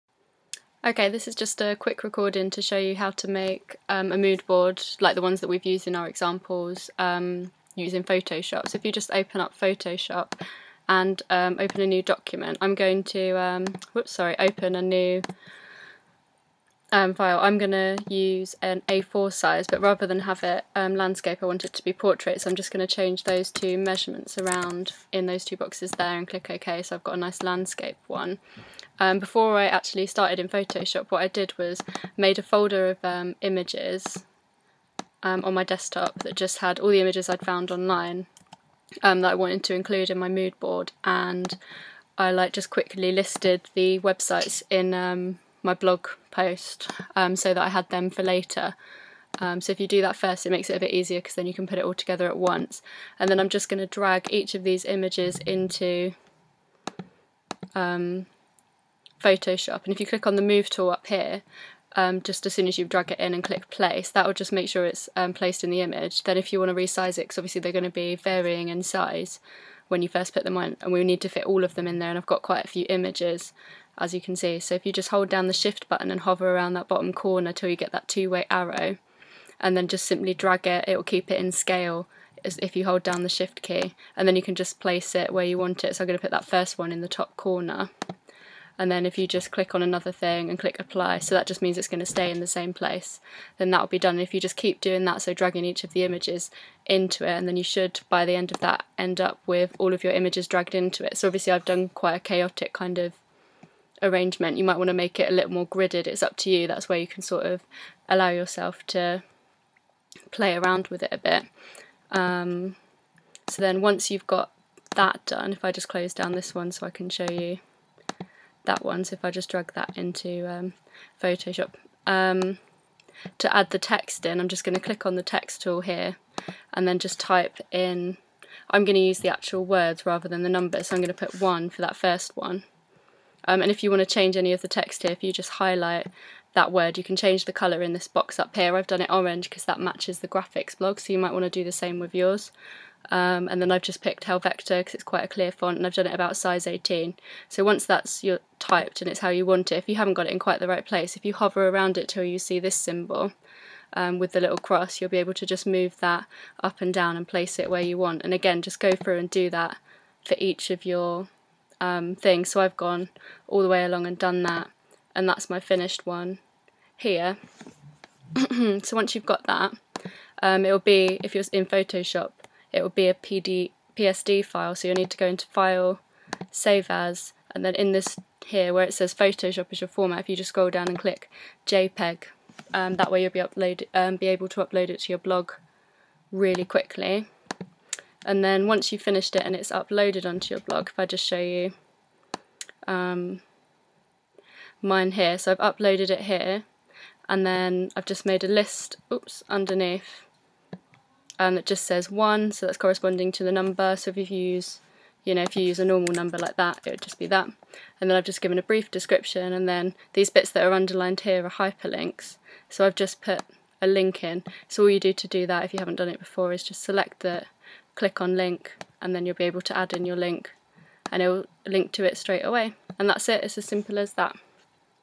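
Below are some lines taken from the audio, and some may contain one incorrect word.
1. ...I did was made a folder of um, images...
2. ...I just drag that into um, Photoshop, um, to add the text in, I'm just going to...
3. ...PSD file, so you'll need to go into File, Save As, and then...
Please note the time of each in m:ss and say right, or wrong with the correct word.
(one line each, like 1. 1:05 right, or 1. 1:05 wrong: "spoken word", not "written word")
1. 0:31 right
2. 1:59 right
3. 2:53 right.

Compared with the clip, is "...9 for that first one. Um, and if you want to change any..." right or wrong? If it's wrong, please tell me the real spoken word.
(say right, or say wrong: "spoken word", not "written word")
wrong: "1", not "9".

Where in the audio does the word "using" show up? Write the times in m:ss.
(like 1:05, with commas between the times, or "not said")
0:07.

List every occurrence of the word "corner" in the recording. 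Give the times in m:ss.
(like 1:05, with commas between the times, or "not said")
1:17, 1:27.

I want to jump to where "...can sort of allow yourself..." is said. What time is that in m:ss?
1:47.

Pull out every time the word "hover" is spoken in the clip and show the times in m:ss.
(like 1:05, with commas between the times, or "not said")
1:16, 2:31.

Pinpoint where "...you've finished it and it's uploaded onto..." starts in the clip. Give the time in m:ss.
3:08.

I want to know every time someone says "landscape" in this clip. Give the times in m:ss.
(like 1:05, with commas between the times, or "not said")
0:20, 0:27.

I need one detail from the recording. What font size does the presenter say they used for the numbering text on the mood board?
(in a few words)
18.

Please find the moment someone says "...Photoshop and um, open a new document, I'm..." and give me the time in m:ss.
0:09.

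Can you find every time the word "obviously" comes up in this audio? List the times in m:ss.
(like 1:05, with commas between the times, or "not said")
1:07, 1:41.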